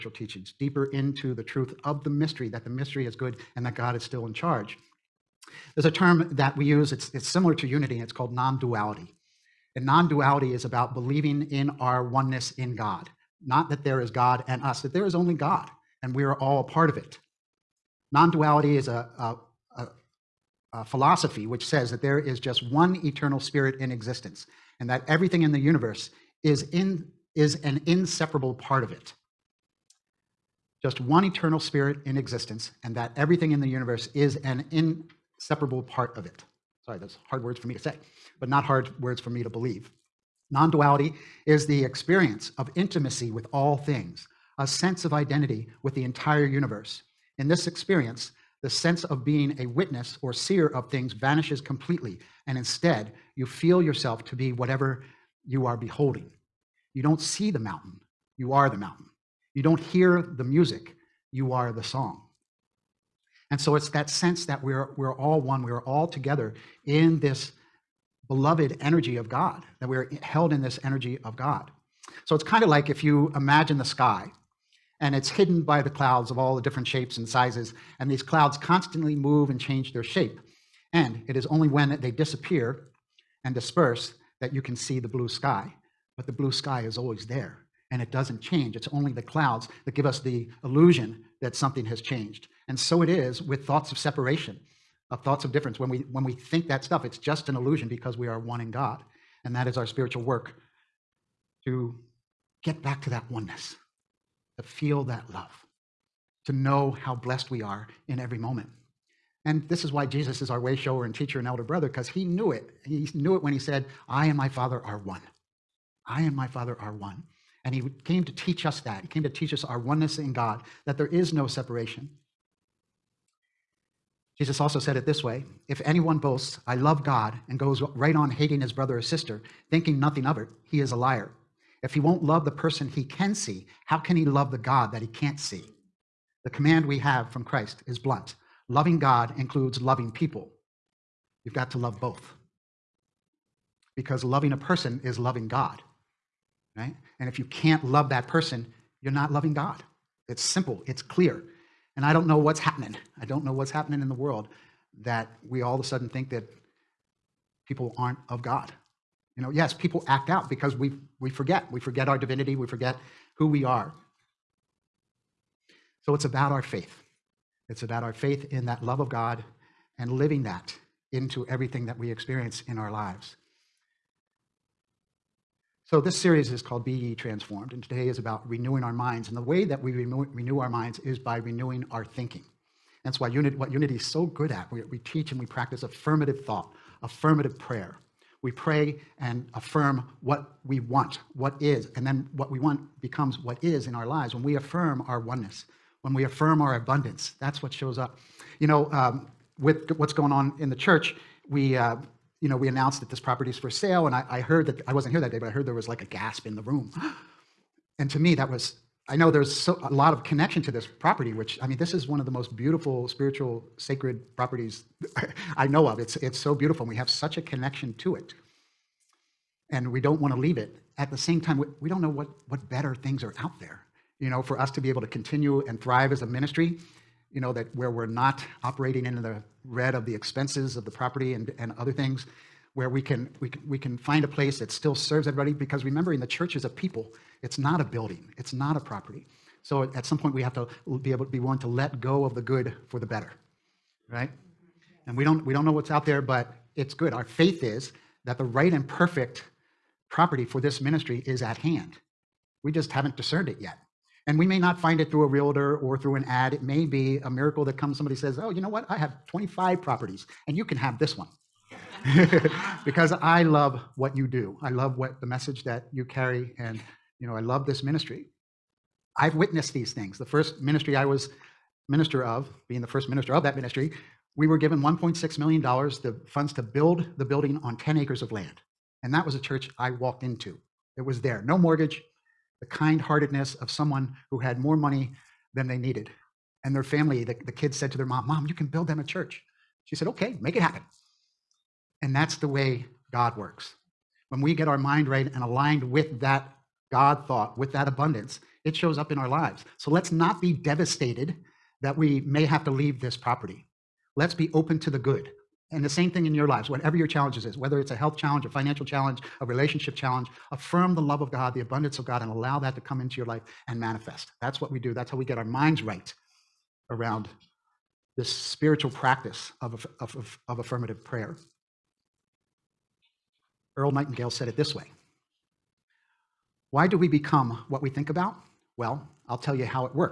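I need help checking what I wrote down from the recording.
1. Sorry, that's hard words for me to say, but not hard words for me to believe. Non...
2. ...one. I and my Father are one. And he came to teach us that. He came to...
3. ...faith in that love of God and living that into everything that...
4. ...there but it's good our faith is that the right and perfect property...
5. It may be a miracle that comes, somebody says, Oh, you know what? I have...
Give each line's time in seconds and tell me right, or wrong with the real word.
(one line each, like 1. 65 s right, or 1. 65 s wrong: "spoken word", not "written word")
1. 36 s right
2. 114 s right
3. 168 s right
4. 246 s right
5. 256 s right.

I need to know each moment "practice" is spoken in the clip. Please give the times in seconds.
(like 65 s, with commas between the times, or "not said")
185 s, 318 s.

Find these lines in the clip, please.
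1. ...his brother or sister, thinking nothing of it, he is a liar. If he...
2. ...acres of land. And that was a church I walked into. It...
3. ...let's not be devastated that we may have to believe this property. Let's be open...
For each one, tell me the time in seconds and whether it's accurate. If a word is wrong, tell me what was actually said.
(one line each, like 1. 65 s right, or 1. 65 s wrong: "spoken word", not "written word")
1. 128 s right
2. 277 s right
3. 299 s wrong: "leave", not "believe".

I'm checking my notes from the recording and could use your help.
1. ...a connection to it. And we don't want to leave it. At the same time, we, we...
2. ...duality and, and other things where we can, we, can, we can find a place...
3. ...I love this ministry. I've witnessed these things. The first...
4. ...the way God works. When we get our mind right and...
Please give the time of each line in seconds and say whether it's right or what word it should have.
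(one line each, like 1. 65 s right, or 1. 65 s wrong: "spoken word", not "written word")
1. 217 s right
2. 230 s wrong: "property", not "duality"
3. 267 s right
4. 292 s right.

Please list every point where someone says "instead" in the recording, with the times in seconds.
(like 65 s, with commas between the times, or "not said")
52 s.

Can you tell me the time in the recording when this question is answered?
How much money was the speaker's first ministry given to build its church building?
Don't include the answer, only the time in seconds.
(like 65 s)
274 s.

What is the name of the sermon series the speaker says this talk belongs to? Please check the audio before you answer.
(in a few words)
Be Ye Transformed.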